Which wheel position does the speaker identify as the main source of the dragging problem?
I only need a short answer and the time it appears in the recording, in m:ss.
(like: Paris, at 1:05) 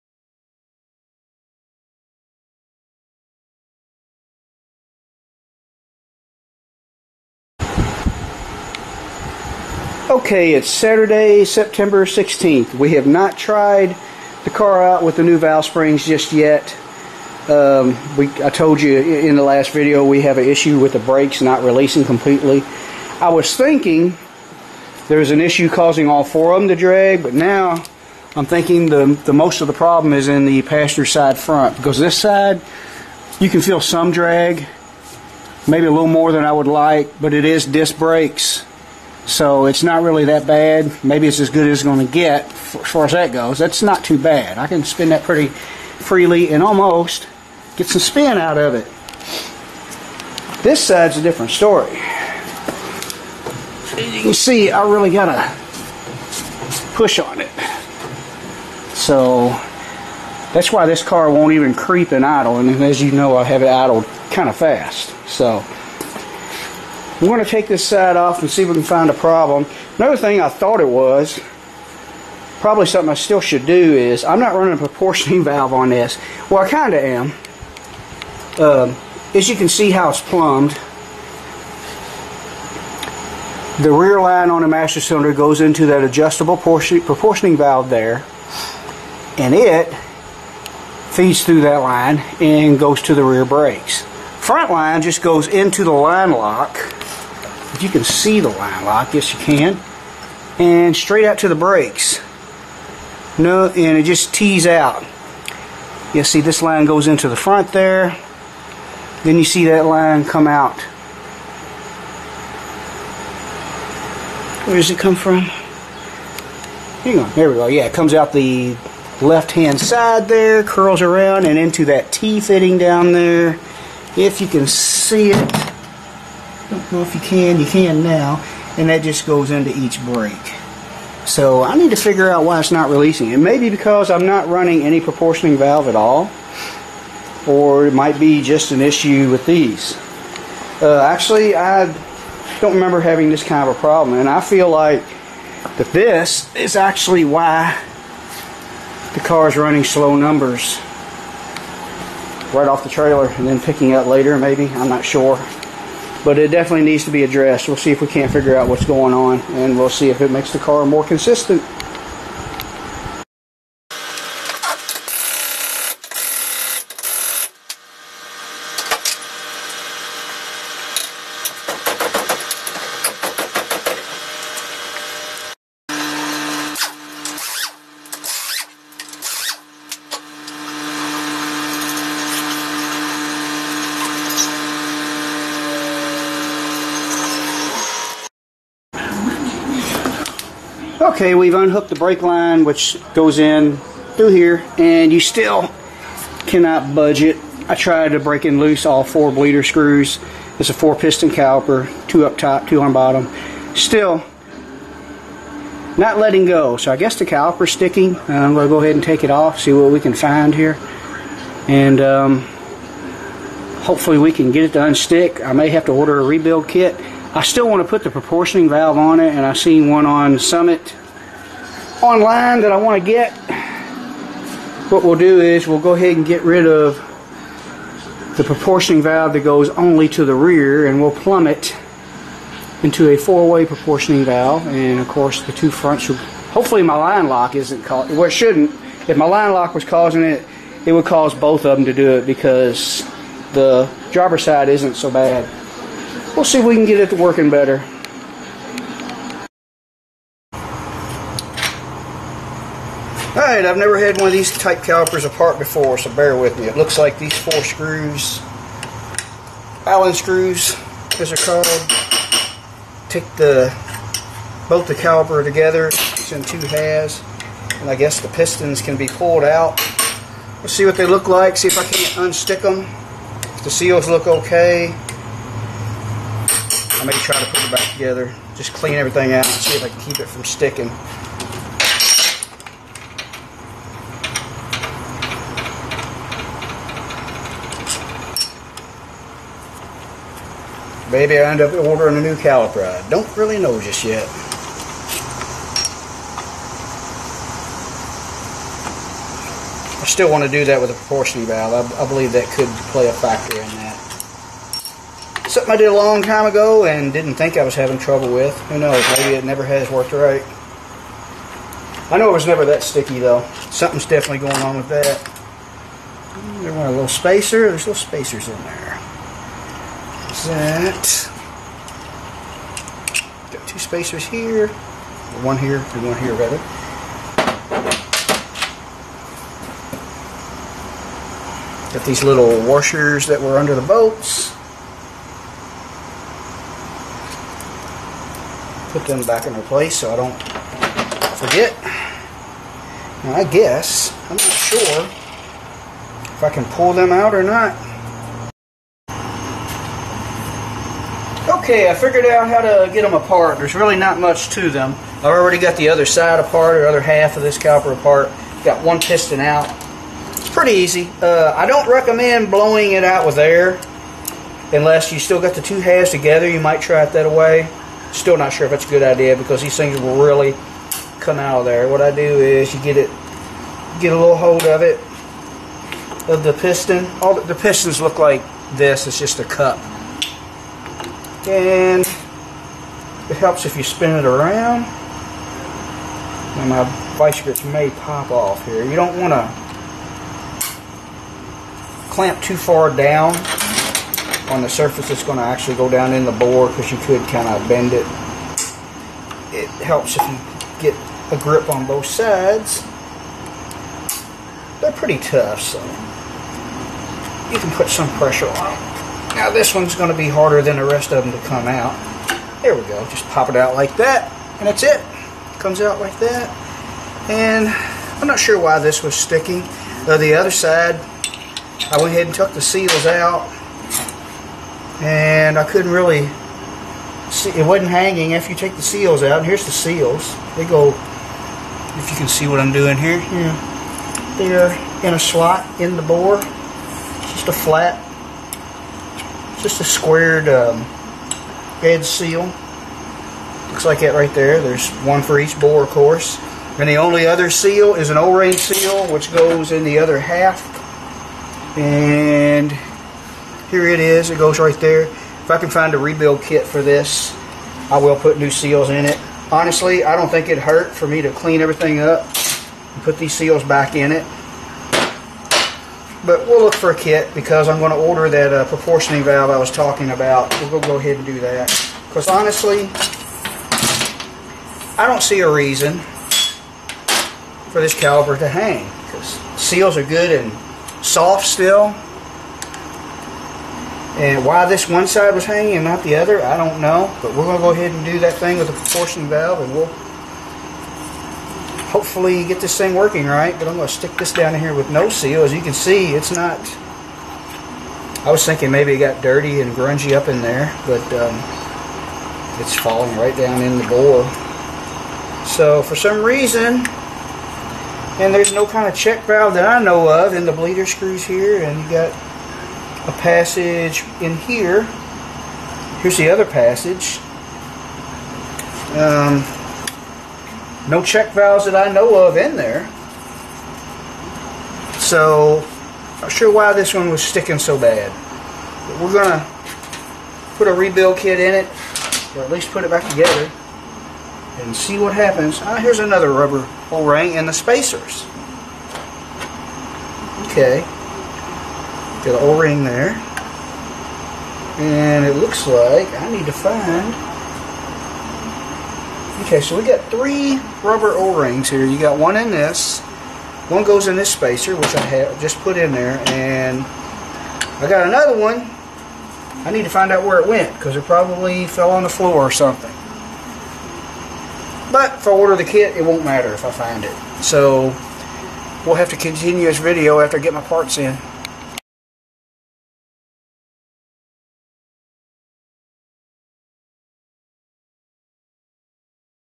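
Passenger side front, at 0:30.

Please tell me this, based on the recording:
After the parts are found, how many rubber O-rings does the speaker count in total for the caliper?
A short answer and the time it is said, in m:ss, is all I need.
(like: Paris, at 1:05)
3, at 9:10.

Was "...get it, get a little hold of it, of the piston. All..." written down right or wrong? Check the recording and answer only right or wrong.
right.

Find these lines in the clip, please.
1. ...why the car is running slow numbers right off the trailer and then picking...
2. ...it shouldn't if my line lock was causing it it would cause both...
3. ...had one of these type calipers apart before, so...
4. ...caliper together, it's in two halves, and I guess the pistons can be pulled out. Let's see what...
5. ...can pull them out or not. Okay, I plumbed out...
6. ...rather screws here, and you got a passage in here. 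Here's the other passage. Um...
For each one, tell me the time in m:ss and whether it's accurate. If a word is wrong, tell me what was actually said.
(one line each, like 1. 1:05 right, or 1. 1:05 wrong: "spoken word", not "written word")
1. 2:27 right
2. 3:58 right
3. 4:13 right
4. 4:24 right
5. 5:46 wrong: "figured", not "plumbed"
6. 8:30 wrong: "bleeder", not "rather".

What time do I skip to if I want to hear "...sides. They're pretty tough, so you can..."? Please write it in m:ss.
6:42.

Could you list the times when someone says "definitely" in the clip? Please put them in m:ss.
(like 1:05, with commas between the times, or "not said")
2:36, 5:14.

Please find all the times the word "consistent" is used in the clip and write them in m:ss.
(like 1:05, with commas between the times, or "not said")
2:41.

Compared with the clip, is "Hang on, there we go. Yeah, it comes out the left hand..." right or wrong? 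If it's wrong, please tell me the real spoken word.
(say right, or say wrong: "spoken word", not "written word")
right.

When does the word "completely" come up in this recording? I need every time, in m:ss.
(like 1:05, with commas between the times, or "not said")
0:22.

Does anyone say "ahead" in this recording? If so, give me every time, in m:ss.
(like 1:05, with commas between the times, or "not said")
3:28, 3:45, 7:02, 7:50, 8:07.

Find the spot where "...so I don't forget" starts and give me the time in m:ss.
5:39.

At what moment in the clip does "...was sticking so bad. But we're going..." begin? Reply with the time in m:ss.
8:47.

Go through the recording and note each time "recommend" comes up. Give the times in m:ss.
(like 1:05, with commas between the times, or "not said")
6:01.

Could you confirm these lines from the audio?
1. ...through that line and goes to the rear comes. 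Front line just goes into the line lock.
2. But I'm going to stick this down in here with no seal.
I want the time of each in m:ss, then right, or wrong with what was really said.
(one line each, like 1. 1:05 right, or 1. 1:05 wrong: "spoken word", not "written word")
1. 1:31 wrong: "brakes", not "comes"
2. 8:13 right.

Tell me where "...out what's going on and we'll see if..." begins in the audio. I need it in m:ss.
2:38.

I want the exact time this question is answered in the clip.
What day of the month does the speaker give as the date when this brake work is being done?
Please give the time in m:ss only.
0:11.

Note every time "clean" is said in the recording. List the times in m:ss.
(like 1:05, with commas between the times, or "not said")
4:38, 7:41.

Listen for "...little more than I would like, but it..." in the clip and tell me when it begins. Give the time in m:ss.
0:35.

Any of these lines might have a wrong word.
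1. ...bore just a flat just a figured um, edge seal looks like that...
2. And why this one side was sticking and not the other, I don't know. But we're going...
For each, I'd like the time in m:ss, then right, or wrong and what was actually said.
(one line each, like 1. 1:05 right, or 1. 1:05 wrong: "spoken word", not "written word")
1. 7:16 wrong: "squared", not "figured"
2. 8:04 wrong: "hanging", not "sticking".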